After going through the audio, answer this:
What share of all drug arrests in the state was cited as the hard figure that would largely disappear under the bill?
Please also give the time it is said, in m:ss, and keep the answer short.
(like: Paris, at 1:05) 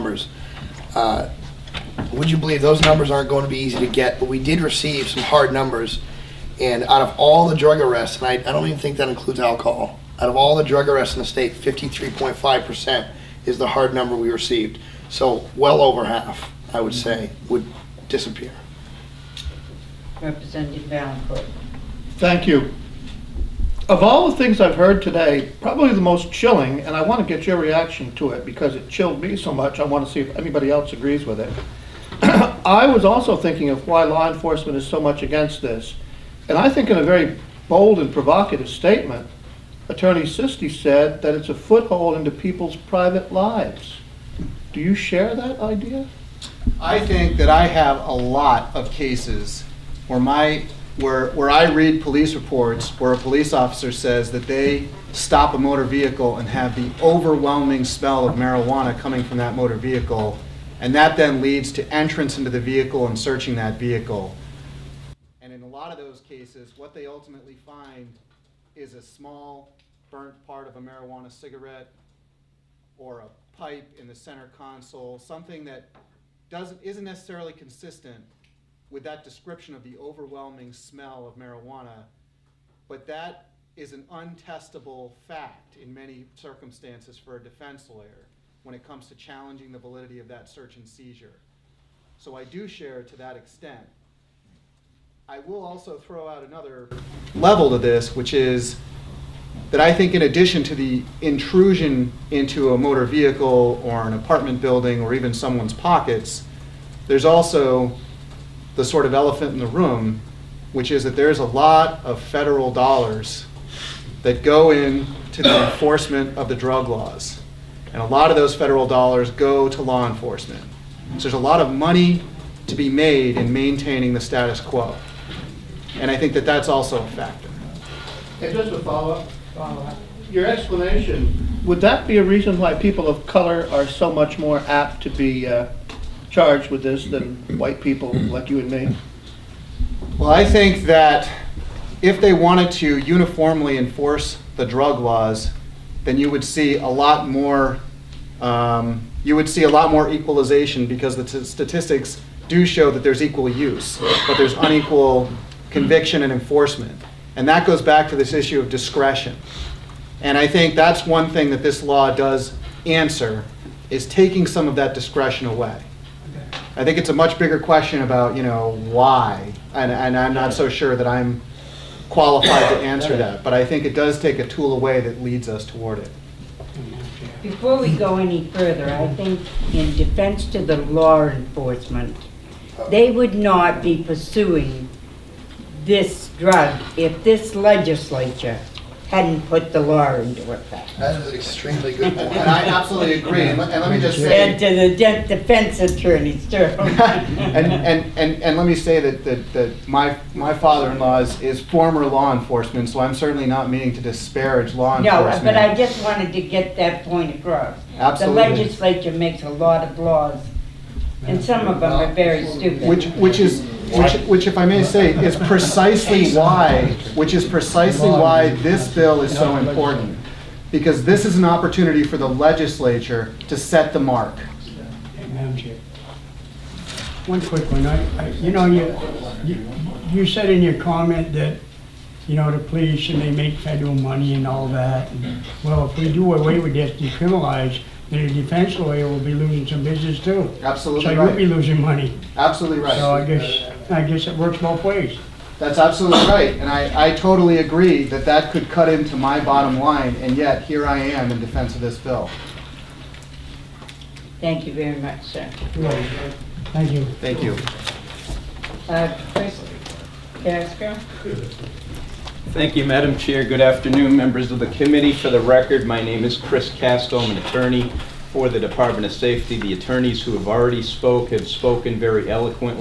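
53.5%, at 0:11.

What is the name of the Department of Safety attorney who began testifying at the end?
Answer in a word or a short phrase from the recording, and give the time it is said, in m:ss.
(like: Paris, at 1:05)
Chris Castle, at 4:26.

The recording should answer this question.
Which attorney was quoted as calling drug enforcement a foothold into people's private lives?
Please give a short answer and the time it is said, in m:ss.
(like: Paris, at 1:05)
Attorney Sisti, at 0:39.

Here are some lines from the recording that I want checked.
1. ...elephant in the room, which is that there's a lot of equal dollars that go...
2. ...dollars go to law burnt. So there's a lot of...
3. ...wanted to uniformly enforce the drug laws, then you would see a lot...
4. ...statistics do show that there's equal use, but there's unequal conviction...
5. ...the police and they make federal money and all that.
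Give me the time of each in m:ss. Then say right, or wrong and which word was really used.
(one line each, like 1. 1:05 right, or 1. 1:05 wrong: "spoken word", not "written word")
1. 1:49 wrong: "federal", not "equal"
2. 1:58 wrong: "enforcement", not "burnt"
3. 2:22 right
4. 2:31 right
5. 3:52 right.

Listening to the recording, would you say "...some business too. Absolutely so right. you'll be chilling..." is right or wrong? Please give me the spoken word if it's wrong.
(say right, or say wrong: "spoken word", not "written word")
wrong: "losing", not "chilling".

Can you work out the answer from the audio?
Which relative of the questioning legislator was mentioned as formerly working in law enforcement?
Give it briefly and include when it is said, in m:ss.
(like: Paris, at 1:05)
Father-in-law, at 3:20.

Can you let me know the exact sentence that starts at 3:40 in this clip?
Because this is an opportunity for the legislature to set the mark.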